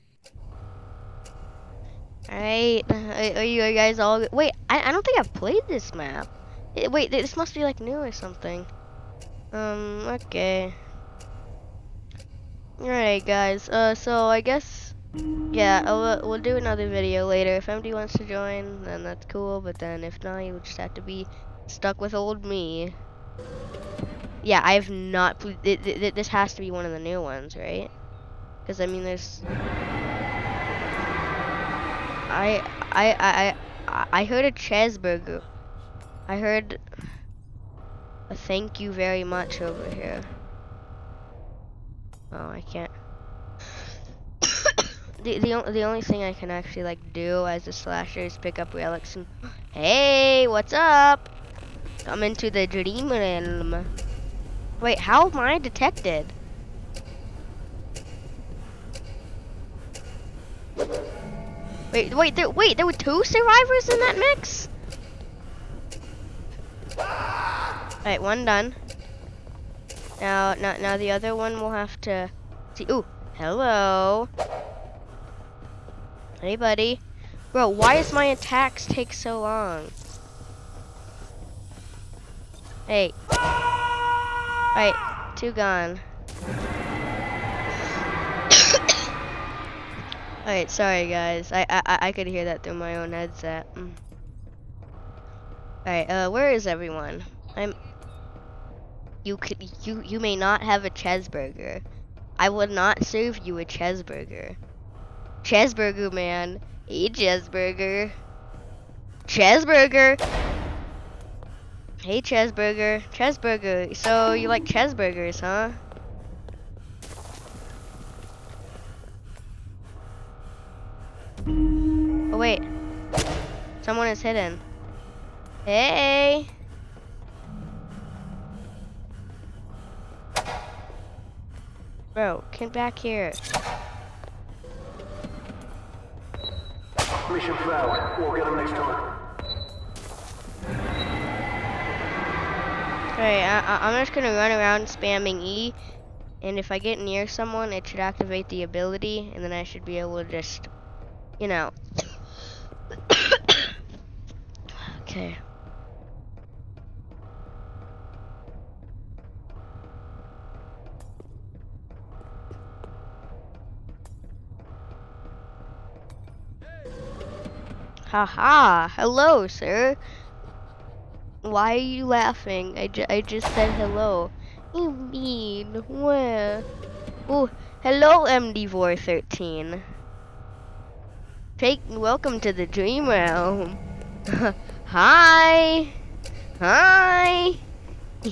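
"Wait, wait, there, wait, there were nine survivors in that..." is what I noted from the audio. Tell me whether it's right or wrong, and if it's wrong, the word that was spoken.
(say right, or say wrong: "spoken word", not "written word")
wrong: "two", not "nine".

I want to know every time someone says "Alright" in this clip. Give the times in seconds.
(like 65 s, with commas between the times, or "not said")
2 s, 12 s, 66 s, 83 s, 90 s, 95 s, 143 s.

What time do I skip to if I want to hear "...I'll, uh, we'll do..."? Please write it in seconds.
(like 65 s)
15 s.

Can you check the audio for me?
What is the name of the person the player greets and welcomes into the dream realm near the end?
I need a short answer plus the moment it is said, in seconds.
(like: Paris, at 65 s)
MD 13, at 178 s.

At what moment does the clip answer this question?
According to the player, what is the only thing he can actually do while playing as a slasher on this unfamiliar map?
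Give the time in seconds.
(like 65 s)
48 s.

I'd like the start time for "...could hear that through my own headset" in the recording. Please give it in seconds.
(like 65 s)
92 s.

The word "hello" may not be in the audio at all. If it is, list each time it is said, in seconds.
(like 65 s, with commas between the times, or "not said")
73 s, 168 s, 173 s, 177 s.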